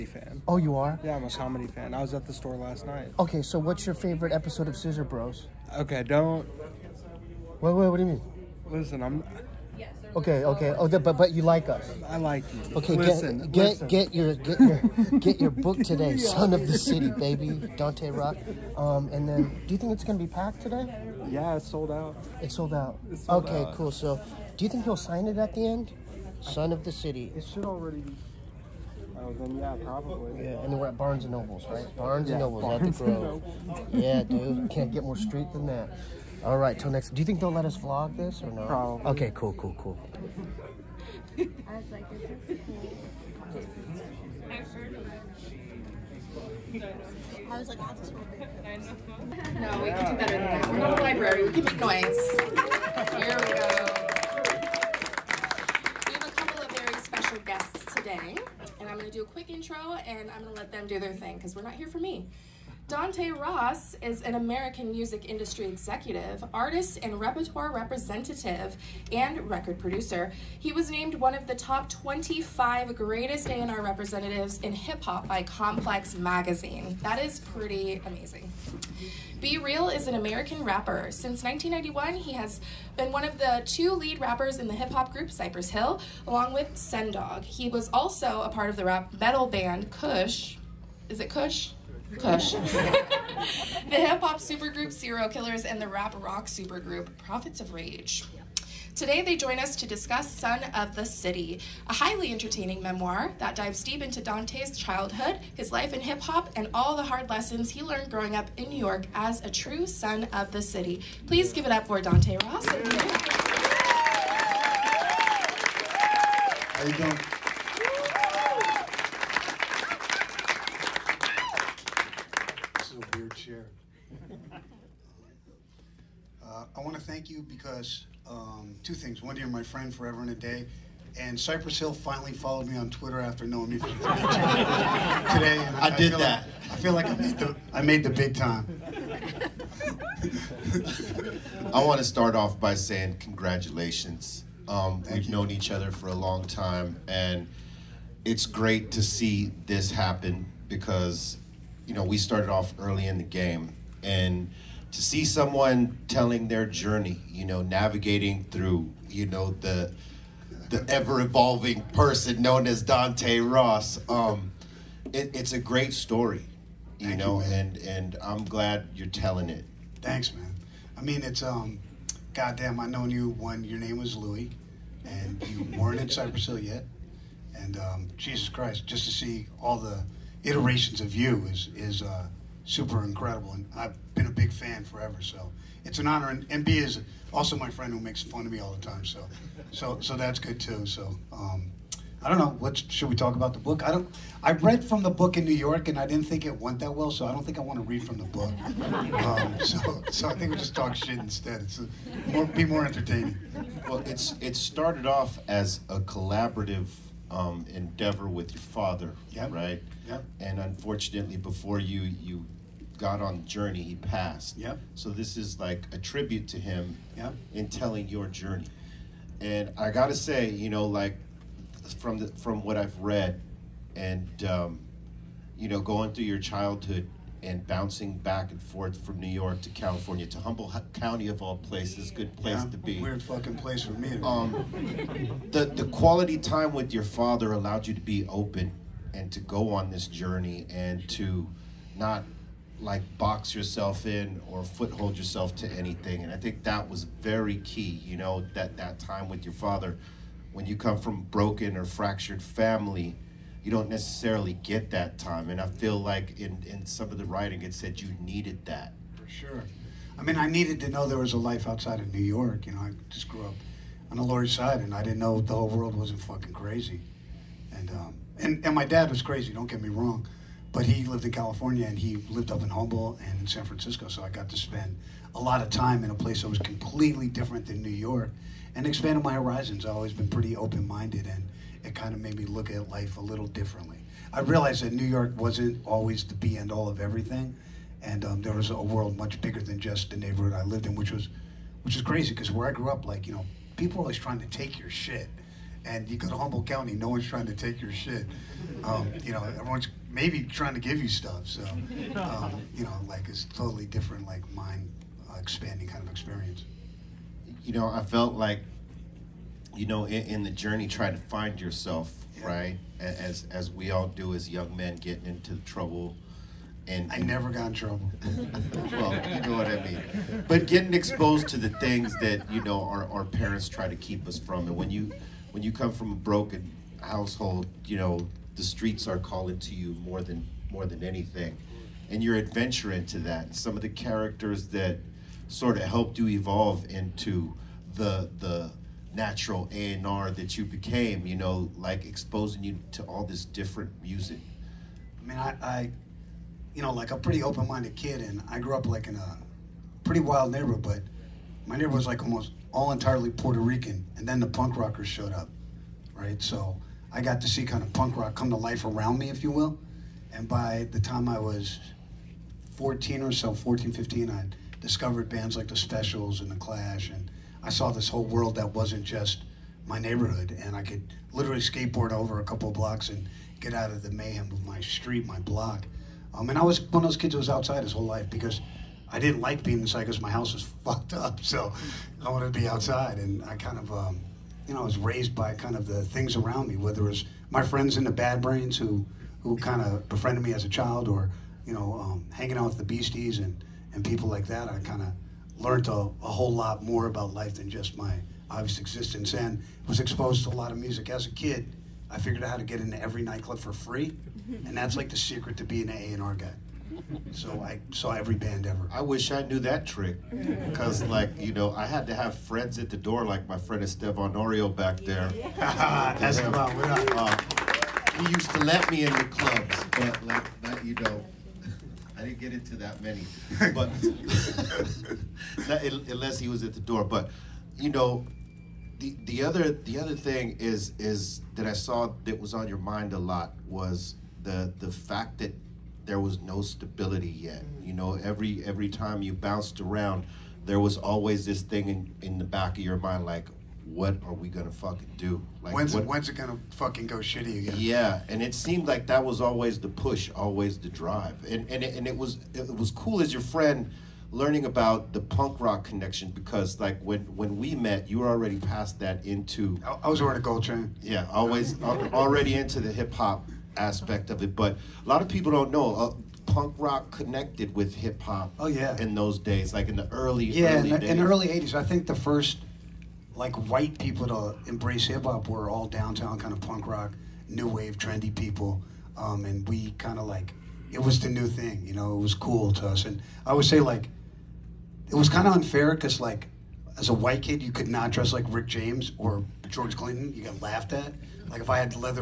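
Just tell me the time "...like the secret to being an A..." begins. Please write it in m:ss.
6:44.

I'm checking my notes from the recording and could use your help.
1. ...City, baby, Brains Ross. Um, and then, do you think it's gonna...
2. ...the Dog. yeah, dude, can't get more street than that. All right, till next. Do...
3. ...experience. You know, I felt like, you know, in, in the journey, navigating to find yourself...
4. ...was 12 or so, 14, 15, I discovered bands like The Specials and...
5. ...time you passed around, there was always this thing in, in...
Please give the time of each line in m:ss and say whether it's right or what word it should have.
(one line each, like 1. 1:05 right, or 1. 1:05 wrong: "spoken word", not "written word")
1. 0:16 wrong: "Dante", not "Brains"
2. 0:33 wrong: "Grove", not "Dog"
3. 5:06 wrong: "trying", not "navigating"
4. 6:01 wrong: "14", not "12"
5. 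7:18 wrong: "bounced", not "passed".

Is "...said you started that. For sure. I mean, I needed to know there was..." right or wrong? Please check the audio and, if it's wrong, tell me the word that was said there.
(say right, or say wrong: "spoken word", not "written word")
wrong: "needed", not "started".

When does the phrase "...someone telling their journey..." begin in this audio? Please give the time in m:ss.
2:35.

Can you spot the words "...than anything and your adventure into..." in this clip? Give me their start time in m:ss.
5:30.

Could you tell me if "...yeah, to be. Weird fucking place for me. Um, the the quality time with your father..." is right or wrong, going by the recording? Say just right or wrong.
right.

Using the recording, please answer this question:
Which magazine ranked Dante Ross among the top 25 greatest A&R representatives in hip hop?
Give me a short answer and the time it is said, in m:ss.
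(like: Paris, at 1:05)
Complex, at 1:15.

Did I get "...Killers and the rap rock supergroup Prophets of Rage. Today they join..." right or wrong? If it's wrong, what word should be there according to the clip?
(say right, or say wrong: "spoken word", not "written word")
right.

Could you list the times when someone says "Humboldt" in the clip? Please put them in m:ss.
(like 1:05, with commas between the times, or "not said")
3:50, 4:32, 4:56.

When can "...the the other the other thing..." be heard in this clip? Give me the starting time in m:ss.
7:08.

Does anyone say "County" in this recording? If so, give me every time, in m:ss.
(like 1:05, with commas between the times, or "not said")
3:50, 4:56.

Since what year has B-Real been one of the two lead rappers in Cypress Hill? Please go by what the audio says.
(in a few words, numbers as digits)
1991.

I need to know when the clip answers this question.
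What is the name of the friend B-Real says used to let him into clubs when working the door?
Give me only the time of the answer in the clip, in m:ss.
6:53.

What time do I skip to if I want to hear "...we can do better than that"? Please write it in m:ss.
0:49.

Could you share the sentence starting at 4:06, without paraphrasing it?
And I think that was very key, you know, that, that time with your father.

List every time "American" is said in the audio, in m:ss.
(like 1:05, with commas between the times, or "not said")
1:04, 1:20.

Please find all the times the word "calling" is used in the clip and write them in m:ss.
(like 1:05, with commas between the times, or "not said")
5:29.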